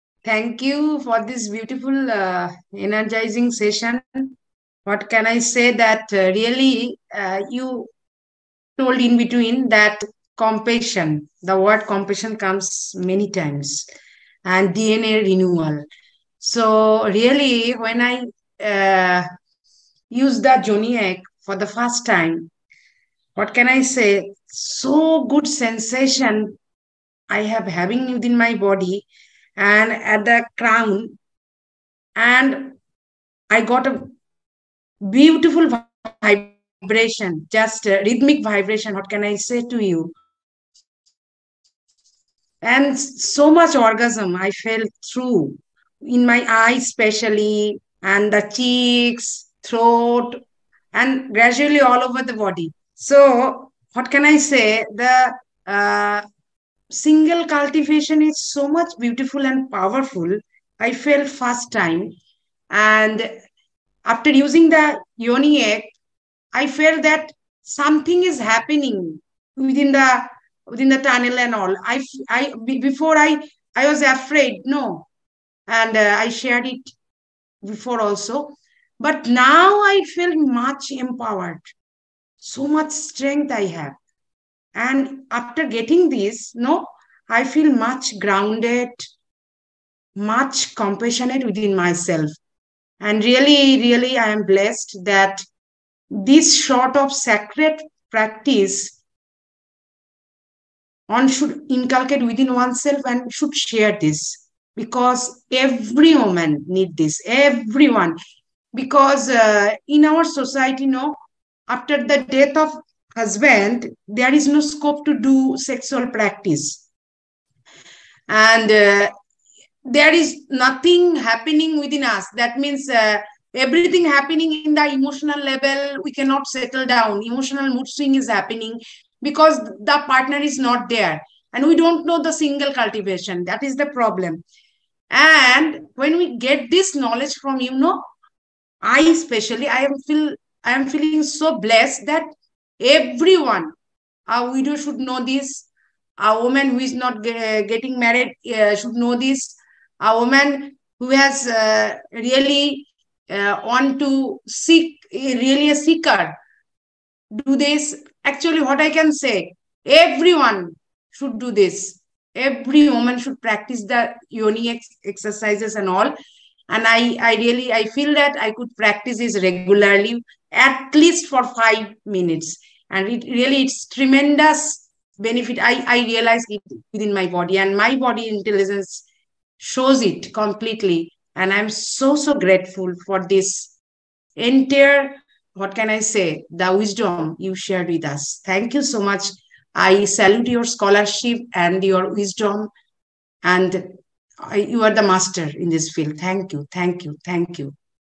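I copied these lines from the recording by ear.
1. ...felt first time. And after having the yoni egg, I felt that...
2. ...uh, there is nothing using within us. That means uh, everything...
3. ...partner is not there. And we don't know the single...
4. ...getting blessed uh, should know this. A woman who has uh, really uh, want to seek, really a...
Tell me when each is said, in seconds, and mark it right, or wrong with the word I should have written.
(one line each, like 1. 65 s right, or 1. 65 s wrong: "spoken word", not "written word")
1. 60 s wrong: "using", not "having"
2. 118 s wrong: "happening", not "using"
3. 130 s right
4. 147 s wrong: "married", not "blessed".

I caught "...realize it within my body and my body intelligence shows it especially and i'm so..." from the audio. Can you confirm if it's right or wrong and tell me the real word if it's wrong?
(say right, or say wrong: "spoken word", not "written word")
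wrong: "completely", not "especially".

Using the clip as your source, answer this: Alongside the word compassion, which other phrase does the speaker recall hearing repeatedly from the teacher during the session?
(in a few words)
DNA renewal.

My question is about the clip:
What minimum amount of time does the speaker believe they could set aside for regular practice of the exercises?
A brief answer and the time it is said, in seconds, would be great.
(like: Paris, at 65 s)
5 minutes, at 171 s.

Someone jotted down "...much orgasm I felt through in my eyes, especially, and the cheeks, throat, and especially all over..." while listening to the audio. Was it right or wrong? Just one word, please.
wrong.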